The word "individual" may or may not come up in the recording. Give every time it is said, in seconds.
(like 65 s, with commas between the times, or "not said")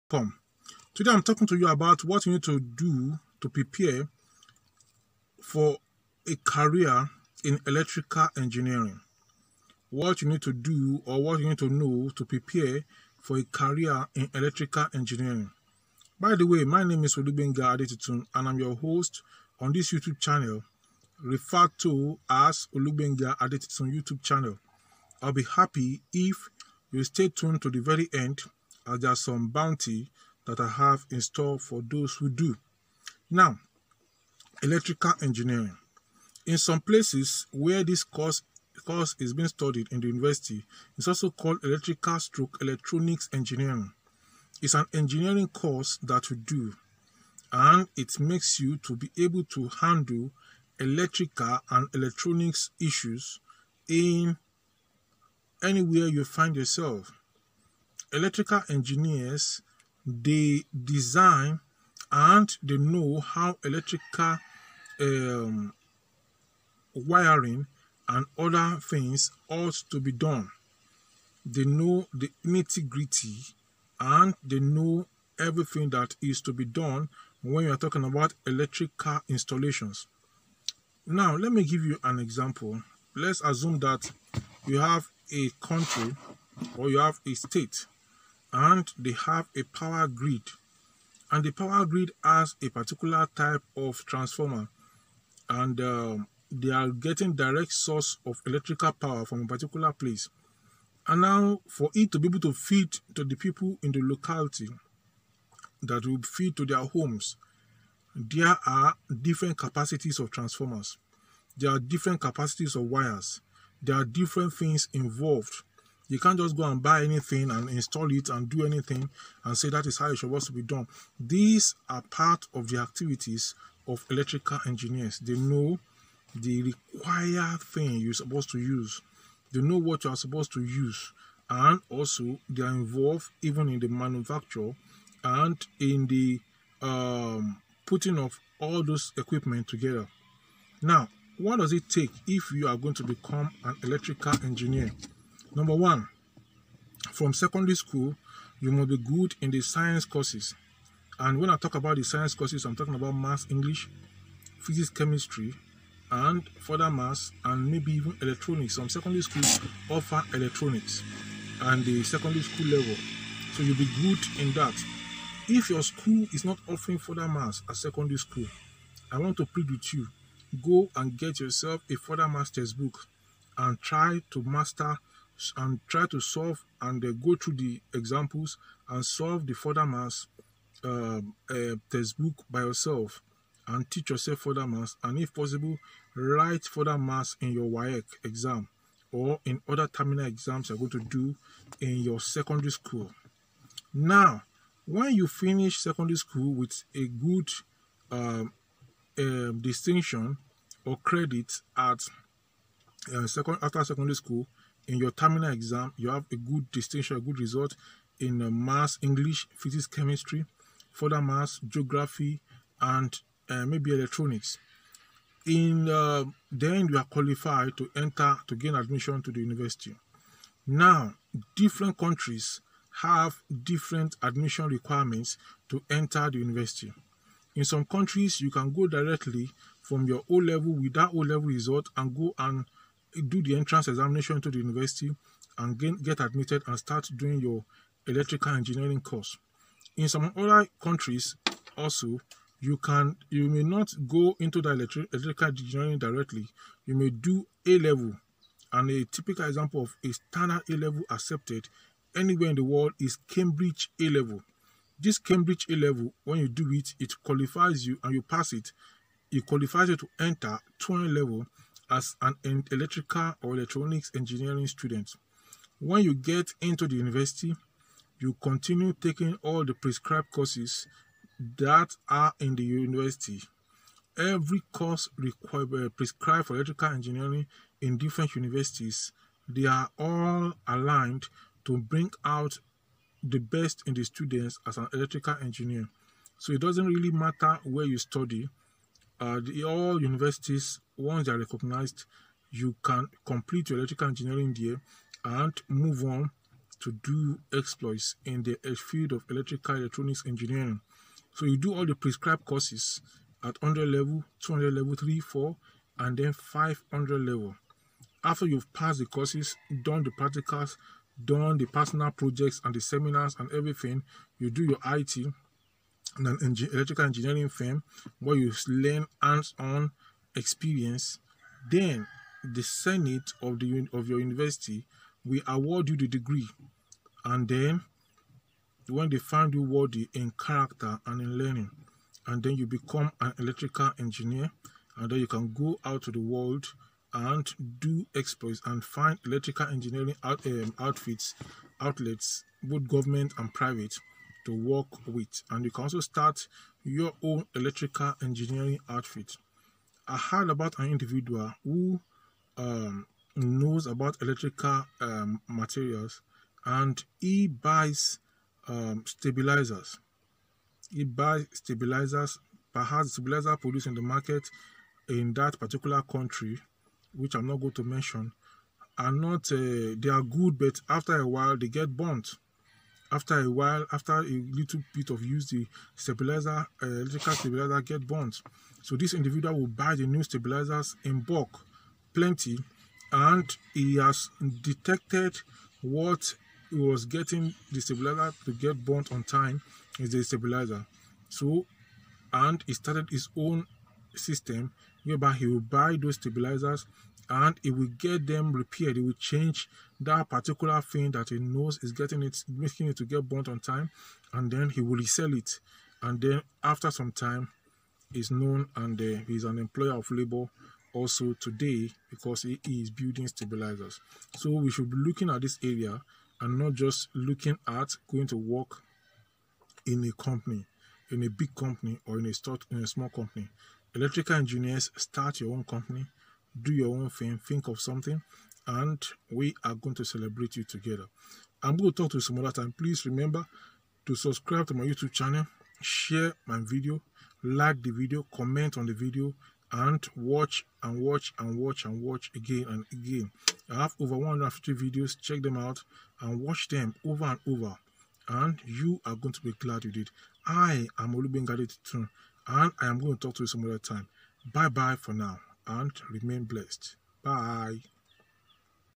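350 s, 379 s.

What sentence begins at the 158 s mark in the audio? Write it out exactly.
Some secondary schools offer electronics and the secondary school level.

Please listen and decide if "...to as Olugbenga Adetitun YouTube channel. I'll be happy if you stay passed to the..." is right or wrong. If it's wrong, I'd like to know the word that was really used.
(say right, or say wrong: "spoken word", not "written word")
wrong: "tuned", not "passed".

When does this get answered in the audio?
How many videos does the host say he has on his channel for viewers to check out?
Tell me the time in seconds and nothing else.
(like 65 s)
443 s.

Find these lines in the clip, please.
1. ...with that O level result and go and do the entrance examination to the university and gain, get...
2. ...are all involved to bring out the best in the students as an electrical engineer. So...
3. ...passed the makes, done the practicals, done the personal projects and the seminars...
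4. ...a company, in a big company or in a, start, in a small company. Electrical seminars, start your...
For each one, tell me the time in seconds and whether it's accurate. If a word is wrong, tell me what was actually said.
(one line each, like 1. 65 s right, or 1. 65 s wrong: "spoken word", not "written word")
1. 230 s right
2. 279 s wrong: "aligned", not "involved"
3. 308 s wrong: "courses", not "makes"
4. 420 s wrong: "engineers", not "seminars".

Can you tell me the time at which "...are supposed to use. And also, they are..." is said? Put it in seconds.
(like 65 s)
130 s.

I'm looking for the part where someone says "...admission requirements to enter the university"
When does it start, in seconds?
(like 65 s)
224 s.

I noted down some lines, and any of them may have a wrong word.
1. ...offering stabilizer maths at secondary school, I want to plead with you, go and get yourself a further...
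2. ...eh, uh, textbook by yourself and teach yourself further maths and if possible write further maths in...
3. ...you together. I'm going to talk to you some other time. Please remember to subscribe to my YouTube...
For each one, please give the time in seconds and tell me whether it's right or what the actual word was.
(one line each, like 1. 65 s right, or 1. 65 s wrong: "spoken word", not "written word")
1. 166 s wrong: "further", not "stabilizer"
2. 181 s right
3. 430 s right.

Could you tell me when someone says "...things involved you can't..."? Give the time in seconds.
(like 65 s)
114 s.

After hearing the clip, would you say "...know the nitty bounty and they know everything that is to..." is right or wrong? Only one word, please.
wrong.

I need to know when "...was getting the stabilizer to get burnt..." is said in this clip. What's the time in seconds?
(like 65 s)
386 s.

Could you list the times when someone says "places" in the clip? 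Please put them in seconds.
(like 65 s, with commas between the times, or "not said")
36 s, 99 s.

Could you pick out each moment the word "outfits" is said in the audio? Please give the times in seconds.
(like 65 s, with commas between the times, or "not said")
340 s, 348 s.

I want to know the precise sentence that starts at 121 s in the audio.
These are part of the activities of electrical engineers.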